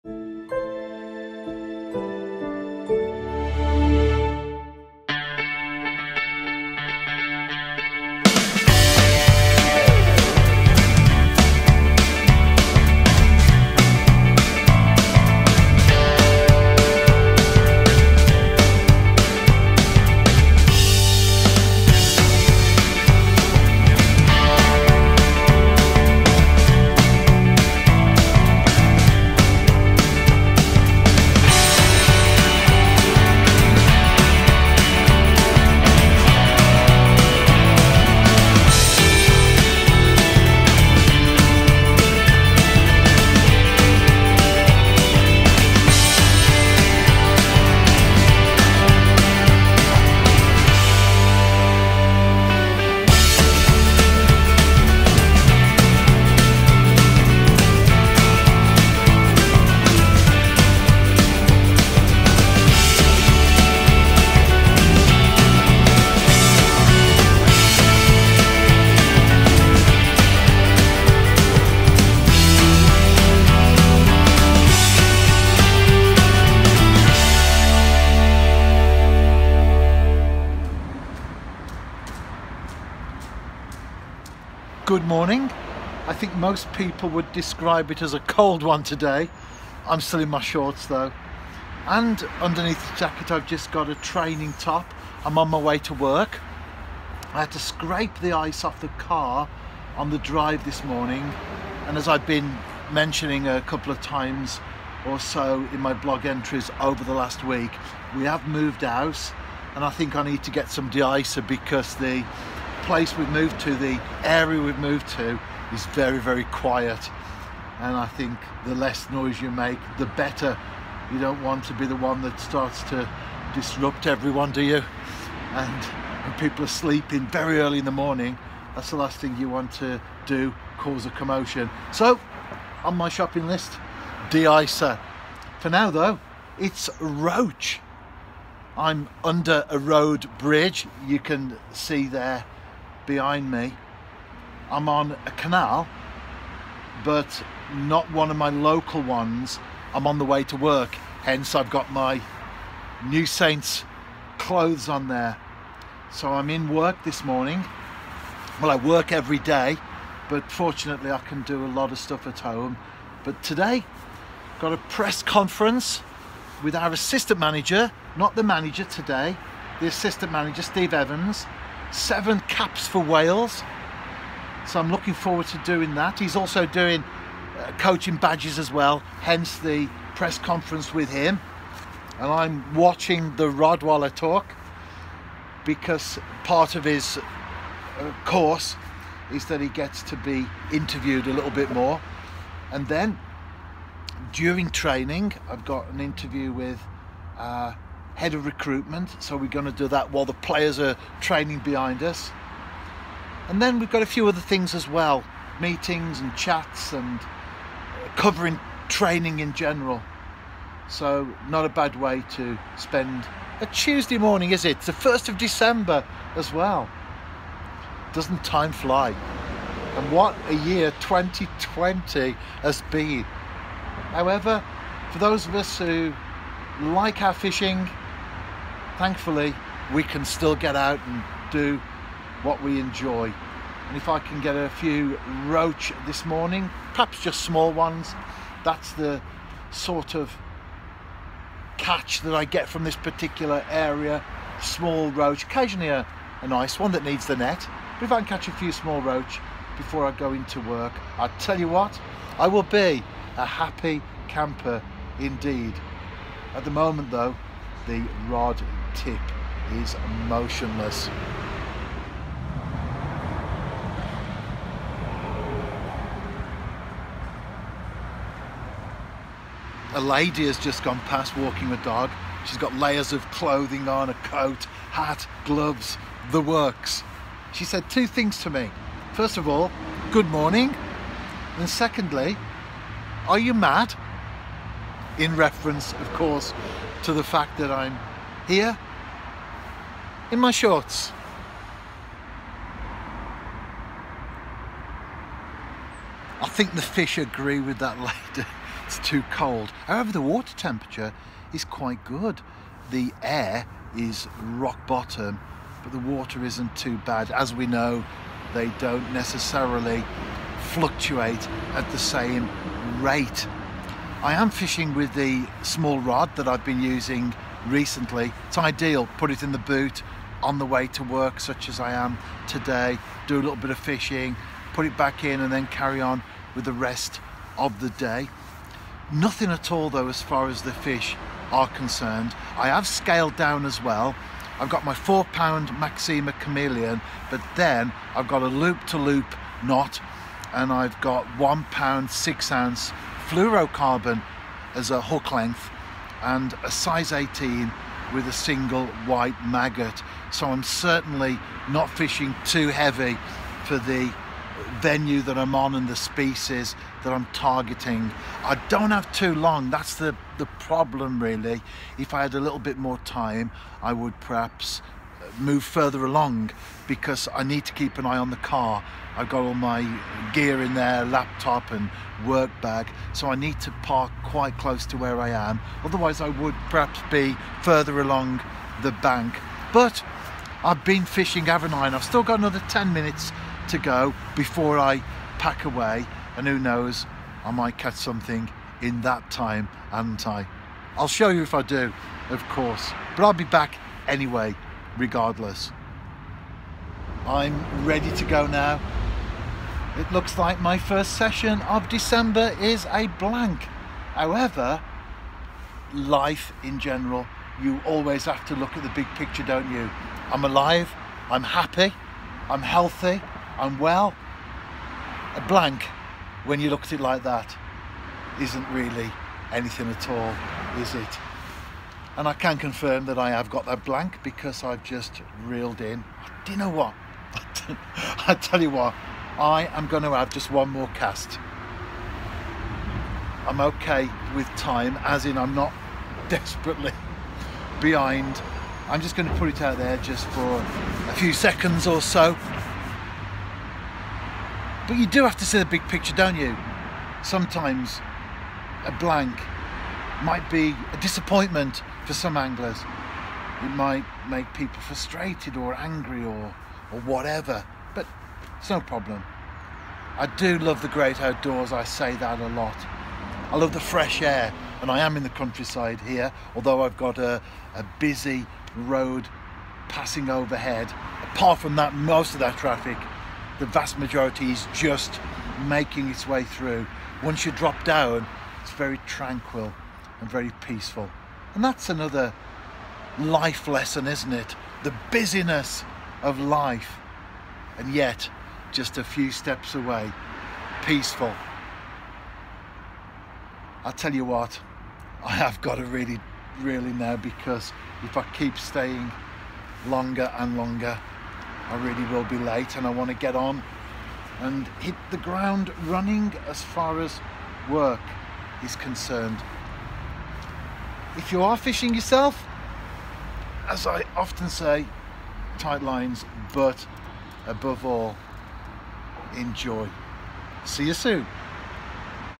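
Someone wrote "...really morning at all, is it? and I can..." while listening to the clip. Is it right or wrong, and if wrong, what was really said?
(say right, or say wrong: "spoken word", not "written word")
wrong: "anything", not "morning".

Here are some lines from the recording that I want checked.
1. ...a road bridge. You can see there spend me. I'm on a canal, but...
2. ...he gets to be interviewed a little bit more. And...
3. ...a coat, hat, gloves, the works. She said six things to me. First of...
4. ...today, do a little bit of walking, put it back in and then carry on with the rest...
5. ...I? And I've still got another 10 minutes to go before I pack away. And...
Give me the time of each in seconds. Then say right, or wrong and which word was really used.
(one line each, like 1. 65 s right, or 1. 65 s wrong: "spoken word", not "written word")
1. 139 s wrong: "behind", not "spend"
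2. 189 s right
3. 274 s wrong: "two", not "six"
4. 322 s wrong: "fishing", not "walking"
5. 381 s right.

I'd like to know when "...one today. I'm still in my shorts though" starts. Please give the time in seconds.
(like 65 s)
88 s.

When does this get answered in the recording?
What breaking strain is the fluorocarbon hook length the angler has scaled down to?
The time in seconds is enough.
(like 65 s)
341 s.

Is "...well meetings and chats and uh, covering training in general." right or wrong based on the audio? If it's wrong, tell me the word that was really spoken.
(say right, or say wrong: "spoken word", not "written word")
right.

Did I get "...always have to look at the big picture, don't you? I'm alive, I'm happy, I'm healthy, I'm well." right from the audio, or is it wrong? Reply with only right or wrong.
right.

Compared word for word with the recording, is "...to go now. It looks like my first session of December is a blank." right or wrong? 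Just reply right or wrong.
right.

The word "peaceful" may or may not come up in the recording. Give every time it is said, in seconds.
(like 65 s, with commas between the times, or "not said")
480 s, 490 s.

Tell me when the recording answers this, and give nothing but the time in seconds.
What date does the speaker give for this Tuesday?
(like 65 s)
214 s.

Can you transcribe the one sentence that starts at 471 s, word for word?
Apart from that, most of that traffic, the vast majority is just making its way through.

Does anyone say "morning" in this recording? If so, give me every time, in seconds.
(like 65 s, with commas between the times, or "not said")
85 s, 100 s, 127 s, 157 s, 214 s, 236 s, 280 s.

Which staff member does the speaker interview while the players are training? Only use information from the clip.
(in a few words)
Head of recruitment.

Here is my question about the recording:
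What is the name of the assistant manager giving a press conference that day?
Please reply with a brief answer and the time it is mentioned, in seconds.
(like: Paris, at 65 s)
Steve Evans, at 170 s.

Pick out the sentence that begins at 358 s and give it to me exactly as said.
I don't have too long, that's the, the problem really.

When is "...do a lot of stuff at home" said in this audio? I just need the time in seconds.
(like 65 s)
161 s.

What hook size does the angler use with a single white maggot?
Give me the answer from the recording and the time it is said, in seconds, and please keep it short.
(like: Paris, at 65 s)
18, at 346 s.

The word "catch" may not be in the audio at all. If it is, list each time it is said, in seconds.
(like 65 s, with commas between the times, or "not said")
241 s, 248 s, 387 s.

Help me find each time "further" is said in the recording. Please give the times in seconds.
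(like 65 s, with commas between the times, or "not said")
365 s, 377 s.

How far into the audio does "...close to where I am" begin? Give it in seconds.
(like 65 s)
374 s.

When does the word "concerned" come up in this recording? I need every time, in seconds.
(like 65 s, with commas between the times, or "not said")
331 s, 508 s.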